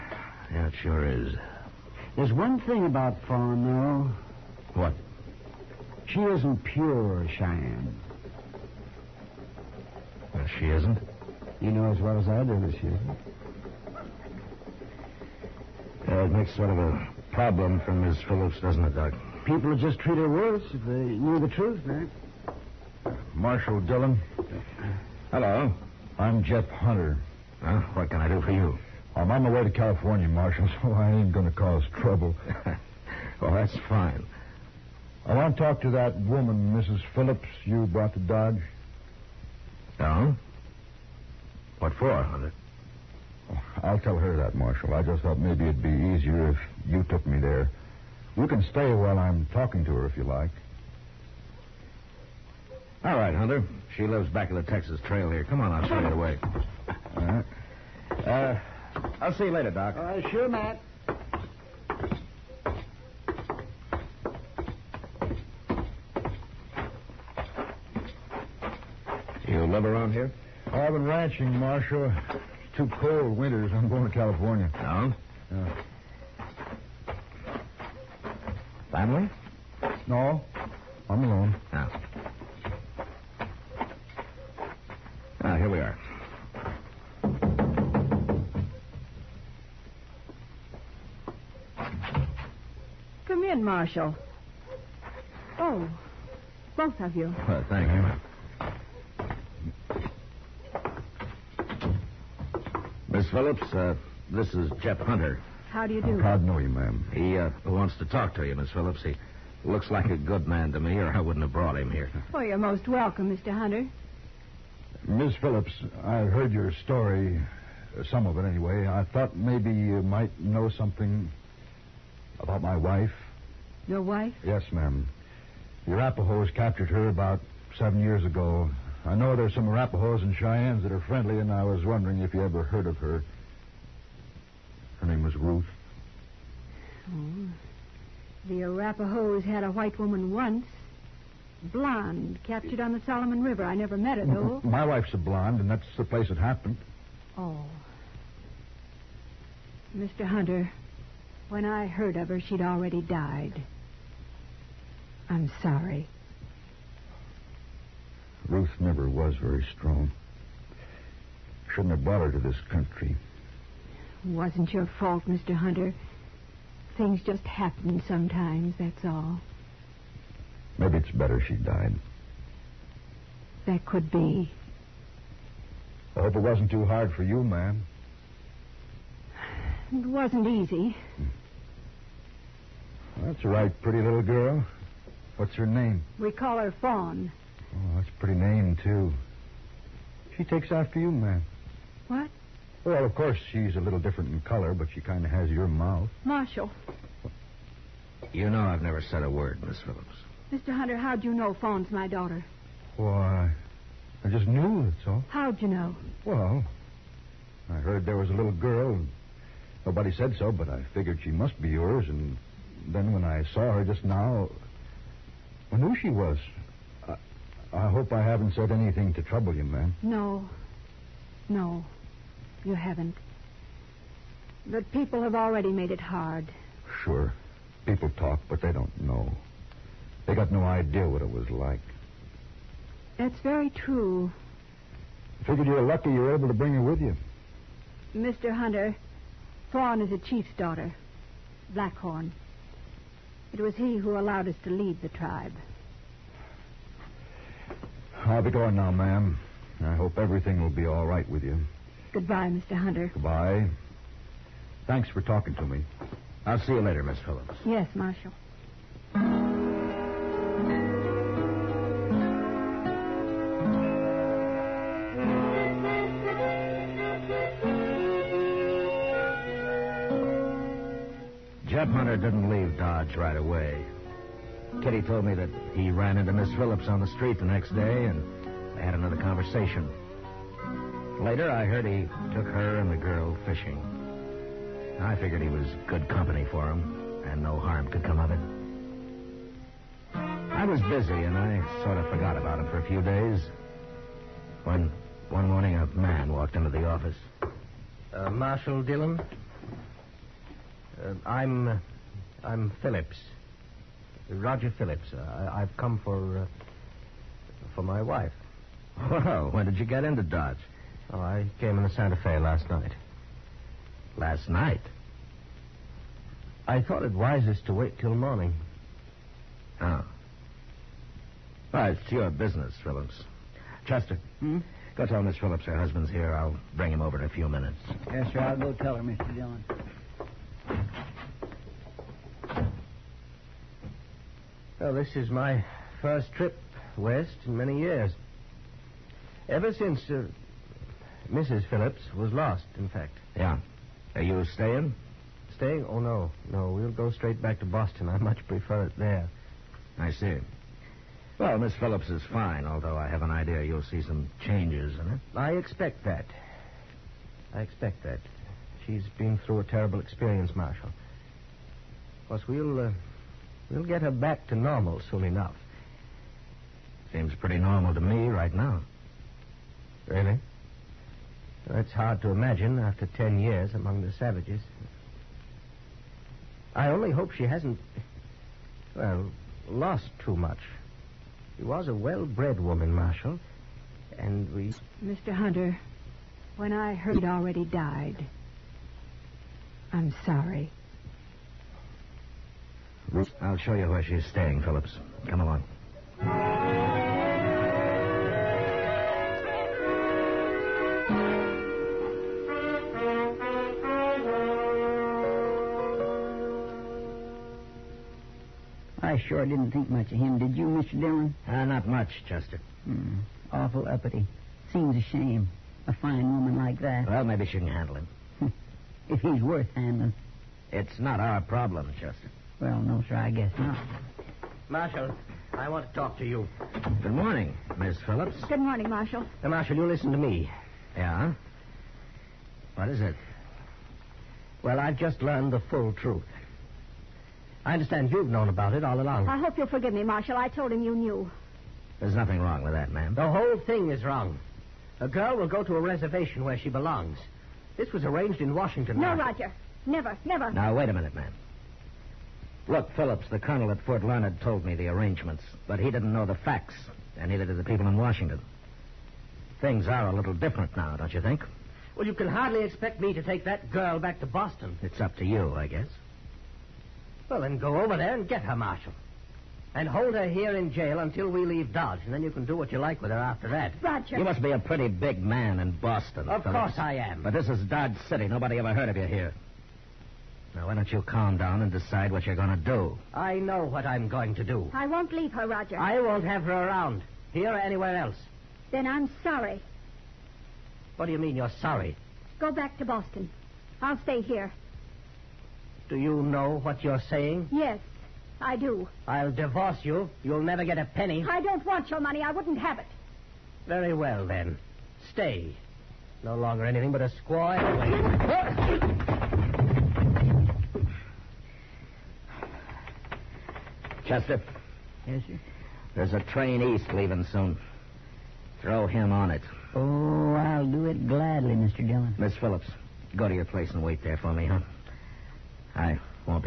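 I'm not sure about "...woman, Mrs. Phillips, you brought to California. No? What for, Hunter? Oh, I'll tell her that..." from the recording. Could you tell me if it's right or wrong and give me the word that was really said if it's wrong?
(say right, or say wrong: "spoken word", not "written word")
wrong: "Dodge", not "California".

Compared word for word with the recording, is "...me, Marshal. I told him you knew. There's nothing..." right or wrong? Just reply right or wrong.
right.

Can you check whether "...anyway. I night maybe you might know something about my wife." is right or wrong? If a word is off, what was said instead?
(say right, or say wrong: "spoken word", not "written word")
wrong: "thought", not "night".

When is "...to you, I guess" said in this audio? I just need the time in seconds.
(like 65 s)
465 s.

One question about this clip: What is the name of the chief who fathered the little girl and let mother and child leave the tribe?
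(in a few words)
Blackhorn.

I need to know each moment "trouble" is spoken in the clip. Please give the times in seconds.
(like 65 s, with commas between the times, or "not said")
31 s, 219 s.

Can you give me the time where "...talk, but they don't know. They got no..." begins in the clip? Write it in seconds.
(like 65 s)
228 s.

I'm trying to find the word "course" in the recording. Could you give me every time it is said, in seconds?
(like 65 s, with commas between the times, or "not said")
193 s, 362 s, 476 s.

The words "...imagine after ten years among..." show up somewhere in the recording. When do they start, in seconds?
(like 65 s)
372 s.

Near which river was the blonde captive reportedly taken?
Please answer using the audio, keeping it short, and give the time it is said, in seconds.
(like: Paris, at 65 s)
Solomon River, at 143 s.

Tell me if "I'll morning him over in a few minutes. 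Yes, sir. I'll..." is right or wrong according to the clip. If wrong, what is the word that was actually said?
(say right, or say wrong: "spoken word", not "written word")
wrong: "bring", not "morning".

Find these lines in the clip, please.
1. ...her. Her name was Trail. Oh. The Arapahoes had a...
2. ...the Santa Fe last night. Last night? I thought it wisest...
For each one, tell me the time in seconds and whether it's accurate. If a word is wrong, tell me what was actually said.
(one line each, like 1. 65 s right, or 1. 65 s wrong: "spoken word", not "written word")
1. 132 s wrong: "Ruth", not "Trail"
2. 311 s right.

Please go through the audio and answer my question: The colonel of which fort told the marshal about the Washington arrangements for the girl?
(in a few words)
Fort Larned.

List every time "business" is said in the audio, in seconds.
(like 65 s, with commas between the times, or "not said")
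322 s.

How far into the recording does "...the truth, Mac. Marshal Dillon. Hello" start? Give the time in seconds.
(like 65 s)
21 s.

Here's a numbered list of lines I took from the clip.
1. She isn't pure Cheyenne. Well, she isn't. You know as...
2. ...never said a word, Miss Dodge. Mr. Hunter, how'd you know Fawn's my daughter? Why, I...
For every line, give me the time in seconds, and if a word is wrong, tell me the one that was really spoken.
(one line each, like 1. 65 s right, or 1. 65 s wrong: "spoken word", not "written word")
1. 6 s right
2. 198 s wrong: "Phillips", not "Dodge".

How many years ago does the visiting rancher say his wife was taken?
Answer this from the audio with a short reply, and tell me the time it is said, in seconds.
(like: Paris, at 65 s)
7, at 127 s.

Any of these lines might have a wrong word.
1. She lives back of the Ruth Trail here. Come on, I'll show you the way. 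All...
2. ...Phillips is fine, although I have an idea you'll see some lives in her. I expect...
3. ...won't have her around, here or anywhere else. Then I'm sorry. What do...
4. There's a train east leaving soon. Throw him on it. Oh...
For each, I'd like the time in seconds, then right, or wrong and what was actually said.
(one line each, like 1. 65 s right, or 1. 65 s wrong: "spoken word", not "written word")
1. 53 s wrong: "Texas", not "Ruth"
2. 351 s wrong: "changes", not "lives"
3. 485 s right
4. 515 s right.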